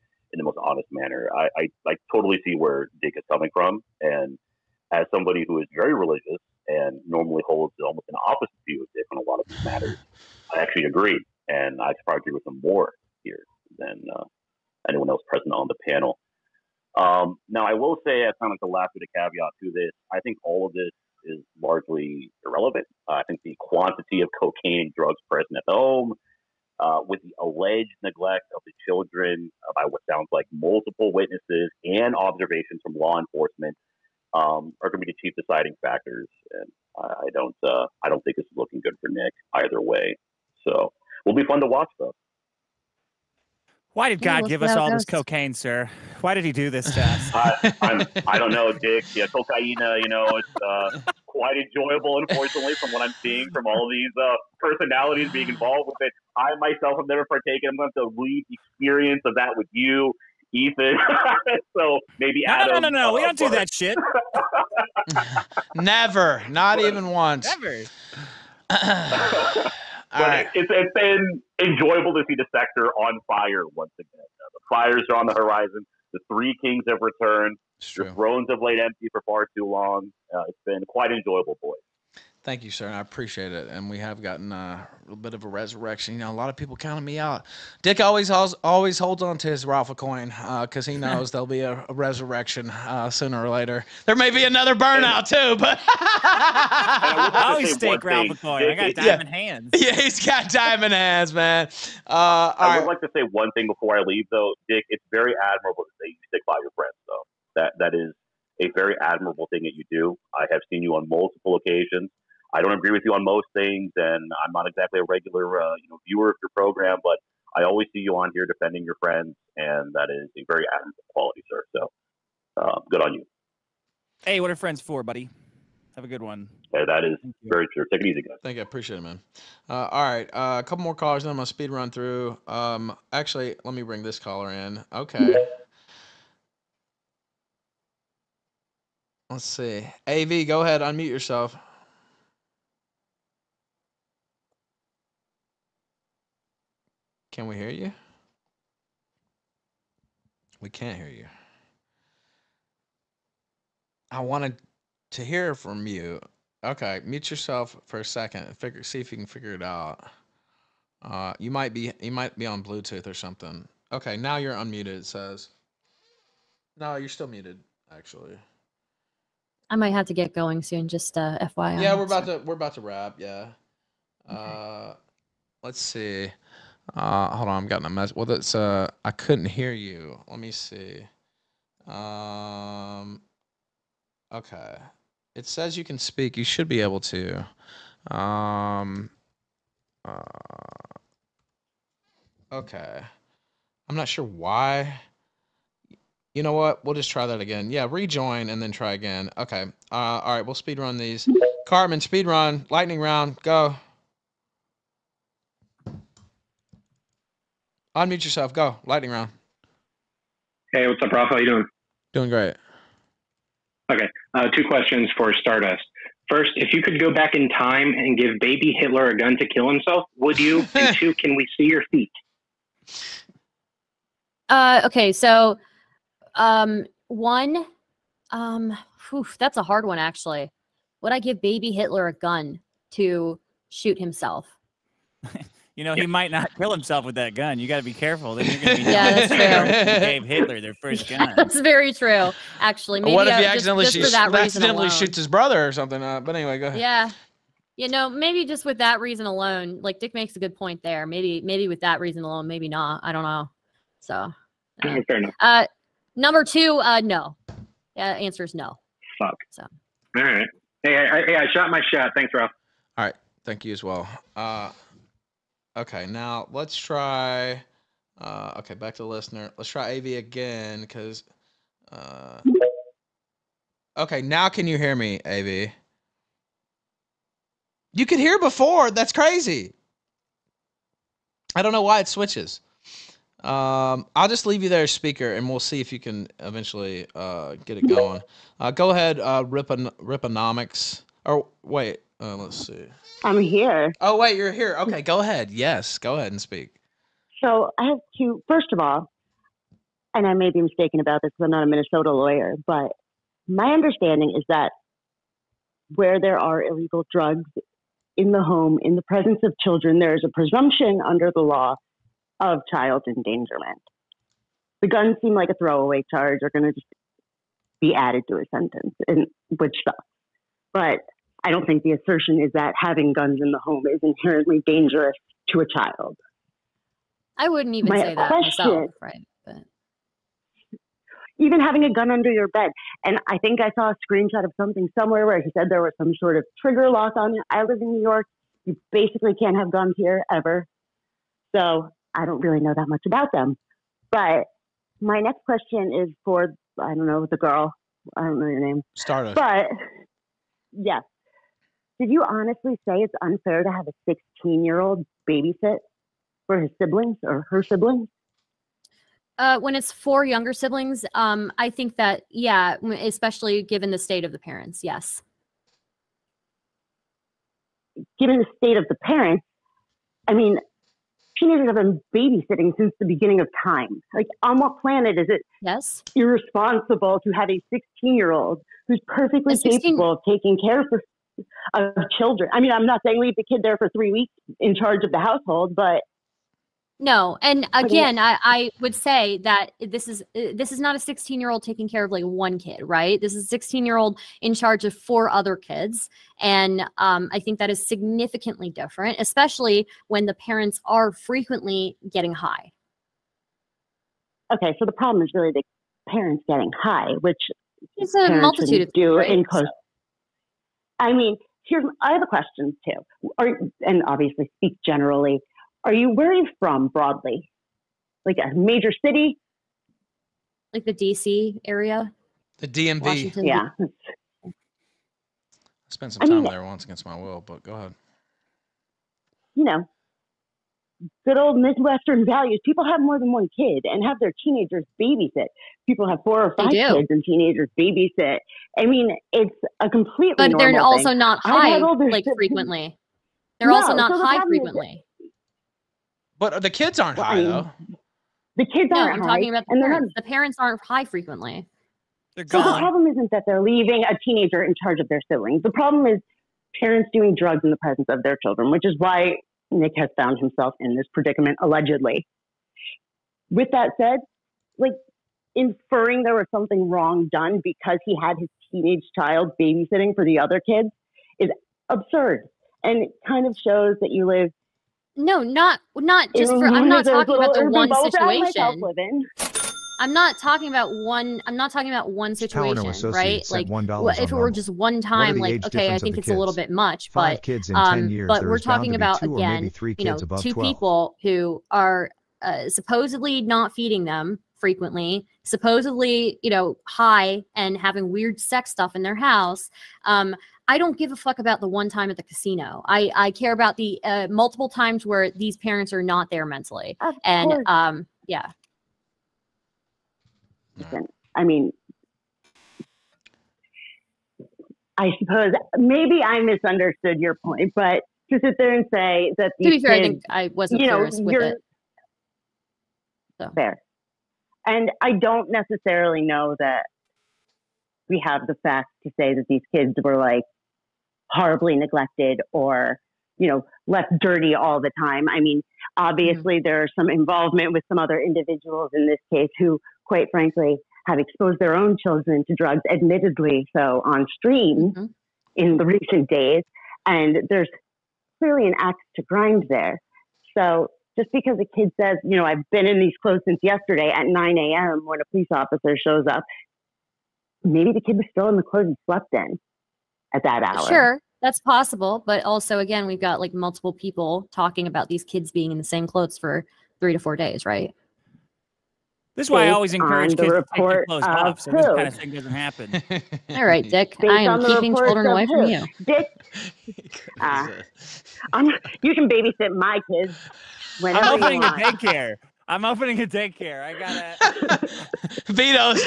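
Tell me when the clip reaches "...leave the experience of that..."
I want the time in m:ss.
0:58.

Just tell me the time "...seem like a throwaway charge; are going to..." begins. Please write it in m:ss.
5:15.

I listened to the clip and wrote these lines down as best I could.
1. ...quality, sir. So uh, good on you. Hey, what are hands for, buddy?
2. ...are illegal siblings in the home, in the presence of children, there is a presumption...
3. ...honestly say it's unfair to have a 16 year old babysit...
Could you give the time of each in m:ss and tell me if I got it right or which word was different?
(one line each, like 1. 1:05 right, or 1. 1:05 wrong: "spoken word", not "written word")
1. 2:01 wrong: "friends", not "hands"
2. 5:06 wrong: "drugs", not "siblings"
3. 5:52 right.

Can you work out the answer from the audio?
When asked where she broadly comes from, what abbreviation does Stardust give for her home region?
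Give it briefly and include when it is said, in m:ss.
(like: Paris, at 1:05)
DMV, at 7:02.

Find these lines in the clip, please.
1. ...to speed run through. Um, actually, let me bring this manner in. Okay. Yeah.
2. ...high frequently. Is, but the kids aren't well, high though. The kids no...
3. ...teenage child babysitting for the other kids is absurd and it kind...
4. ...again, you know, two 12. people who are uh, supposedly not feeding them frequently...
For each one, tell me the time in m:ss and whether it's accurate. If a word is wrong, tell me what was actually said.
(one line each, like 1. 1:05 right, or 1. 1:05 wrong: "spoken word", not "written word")
1. 2:11 wrong: "caller", not "manner"
2. 7:24 right
3. 7:48 right
4. 8:09 right.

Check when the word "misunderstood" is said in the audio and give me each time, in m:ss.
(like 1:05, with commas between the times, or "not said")
8:36.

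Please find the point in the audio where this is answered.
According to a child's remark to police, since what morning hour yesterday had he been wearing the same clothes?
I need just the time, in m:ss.
9:14.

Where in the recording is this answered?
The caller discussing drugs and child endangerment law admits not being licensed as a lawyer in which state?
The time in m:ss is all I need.
5:01.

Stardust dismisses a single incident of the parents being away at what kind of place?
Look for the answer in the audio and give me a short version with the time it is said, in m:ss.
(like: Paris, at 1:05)
Casino, at 8:22.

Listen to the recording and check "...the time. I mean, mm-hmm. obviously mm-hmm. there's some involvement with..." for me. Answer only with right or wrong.
right.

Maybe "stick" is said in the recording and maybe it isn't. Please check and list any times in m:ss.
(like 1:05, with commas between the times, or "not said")
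1:46.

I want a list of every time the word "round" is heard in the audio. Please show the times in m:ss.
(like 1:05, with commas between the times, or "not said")
3:22, 3:29.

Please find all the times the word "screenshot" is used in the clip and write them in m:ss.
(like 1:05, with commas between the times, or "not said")
5:34.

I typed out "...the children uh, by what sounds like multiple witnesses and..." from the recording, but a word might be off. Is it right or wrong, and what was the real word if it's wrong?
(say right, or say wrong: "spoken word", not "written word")
right.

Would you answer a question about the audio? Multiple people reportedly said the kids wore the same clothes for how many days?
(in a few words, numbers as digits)
3 to 4 days.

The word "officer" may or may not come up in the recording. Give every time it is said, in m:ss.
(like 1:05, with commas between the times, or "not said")
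9:15.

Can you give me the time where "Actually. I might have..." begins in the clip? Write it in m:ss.
2:47.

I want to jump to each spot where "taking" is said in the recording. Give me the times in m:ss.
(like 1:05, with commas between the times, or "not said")
6:20, 6:31.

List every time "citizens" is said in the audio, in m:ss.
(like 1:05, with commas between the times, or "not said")
not said.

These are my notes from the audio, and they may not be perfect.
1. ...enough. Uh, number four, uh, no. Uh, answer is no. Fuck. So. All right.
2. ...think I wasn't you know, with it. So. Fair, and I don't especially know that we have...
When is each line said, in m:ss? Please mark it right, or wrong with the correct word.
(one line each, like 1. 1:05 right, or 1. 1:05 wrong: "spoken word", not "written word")
1. 4:15 wrong: "two", not "four"
2. 8:40 wrong: "necessarily", not "especially".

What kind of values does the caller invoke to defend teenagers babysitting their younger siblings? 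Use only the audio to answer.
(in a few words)
Midwestern values.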